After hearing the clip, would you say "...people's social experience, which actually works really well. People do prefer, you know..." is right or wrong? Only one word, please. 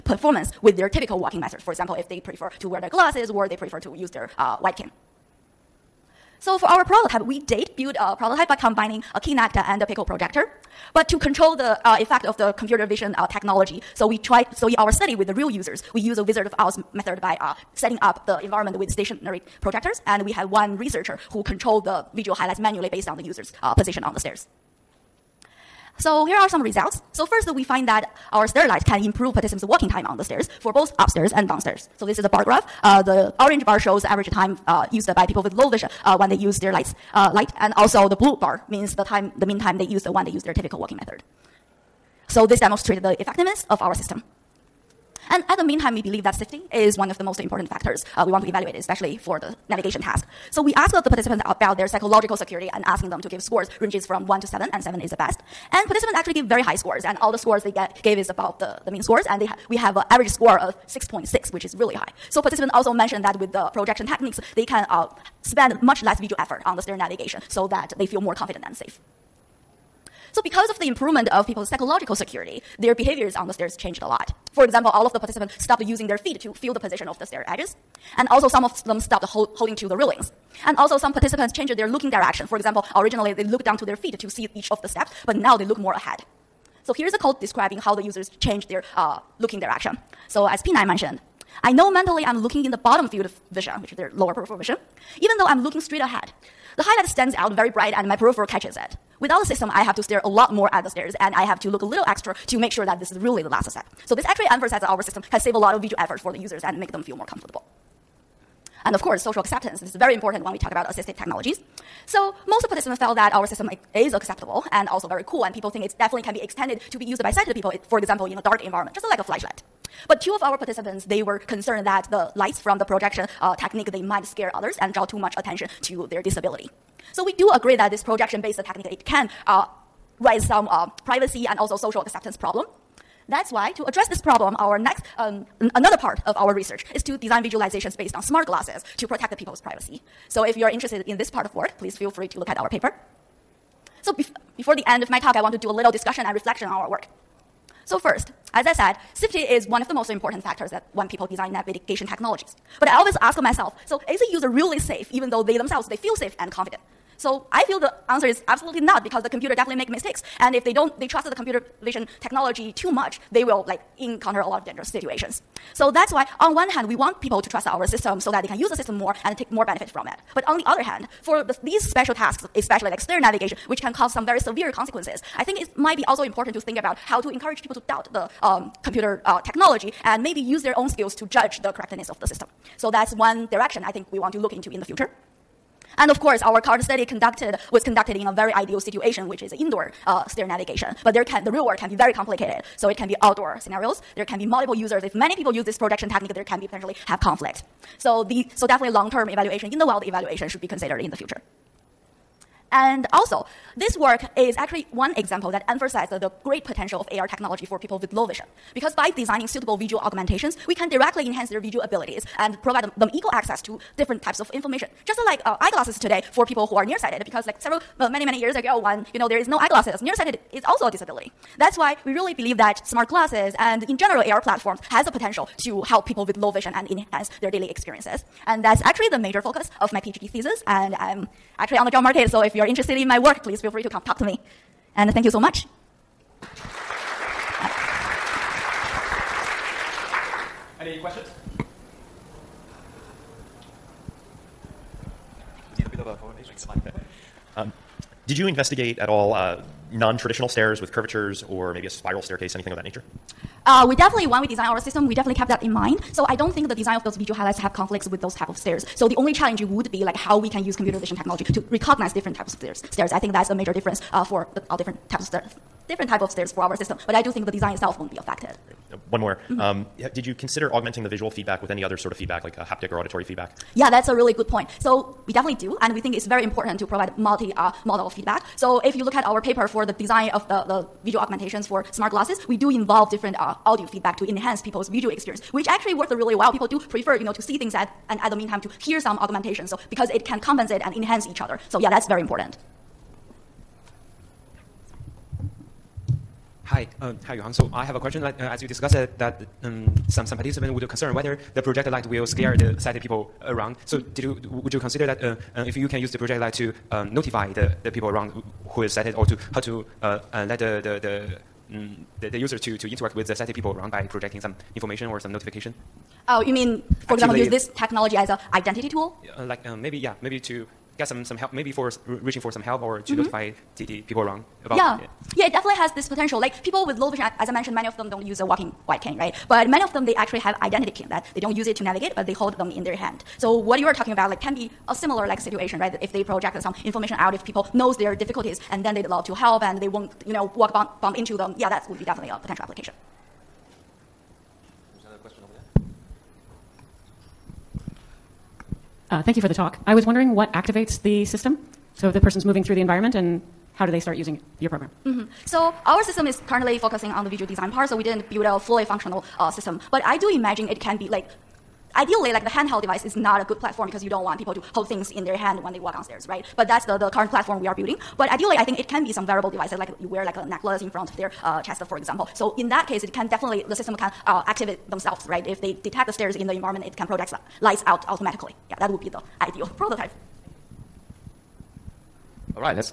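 wrong.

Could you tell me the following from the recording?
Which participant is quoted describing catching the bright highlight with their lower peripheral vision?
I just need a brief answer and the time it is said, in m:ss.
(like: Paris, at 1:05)
P9, at 1:30.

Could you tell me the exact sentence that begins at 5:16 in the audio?
Oh, you mean, for Actively, example, use this technology as an identity tool?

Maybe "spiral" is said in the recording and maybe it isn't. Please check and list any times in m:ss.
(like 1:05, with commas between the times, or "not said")
4:11.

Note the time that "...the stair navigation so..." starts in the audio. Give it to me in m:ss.
1:06.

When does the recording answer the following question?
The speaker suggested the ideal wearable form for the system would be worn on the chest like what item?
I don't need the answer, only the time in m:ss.
6:10.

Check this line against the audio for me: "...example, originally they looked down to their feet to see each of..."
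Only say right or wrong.
right.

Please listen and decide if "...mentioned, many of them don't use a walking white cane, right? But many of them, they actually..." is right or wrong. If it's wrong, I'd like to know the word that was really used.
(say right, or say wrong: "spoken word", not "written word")
right.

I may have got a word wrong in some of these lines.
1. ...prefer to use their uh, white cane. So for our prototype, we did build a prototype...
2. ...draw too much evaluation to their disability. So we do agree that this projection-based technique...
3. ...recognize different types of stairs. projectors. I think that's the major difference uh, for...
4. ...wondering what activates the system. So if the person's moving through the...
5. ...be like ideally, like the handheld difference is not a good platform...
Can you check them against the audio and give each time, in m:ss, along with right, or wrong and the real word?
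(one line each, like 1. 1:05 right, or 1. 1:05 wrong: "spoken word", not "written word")
1. 0:03 right
2. 2:04 wrong: "attention", not "evaluation"
3. 4:21 wrong: "stairs", not "projectors"
4. 5:50 right
5. 6:00 wrong: "device", not "difference".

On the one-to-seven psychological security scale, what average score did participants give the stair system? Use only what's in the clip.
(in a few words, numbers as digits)
6.6.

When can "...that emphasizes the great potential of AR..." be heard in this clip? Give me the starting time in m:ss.
3:25.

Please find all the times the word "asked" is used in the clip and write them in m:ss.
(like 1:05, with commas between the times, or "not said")
0:50.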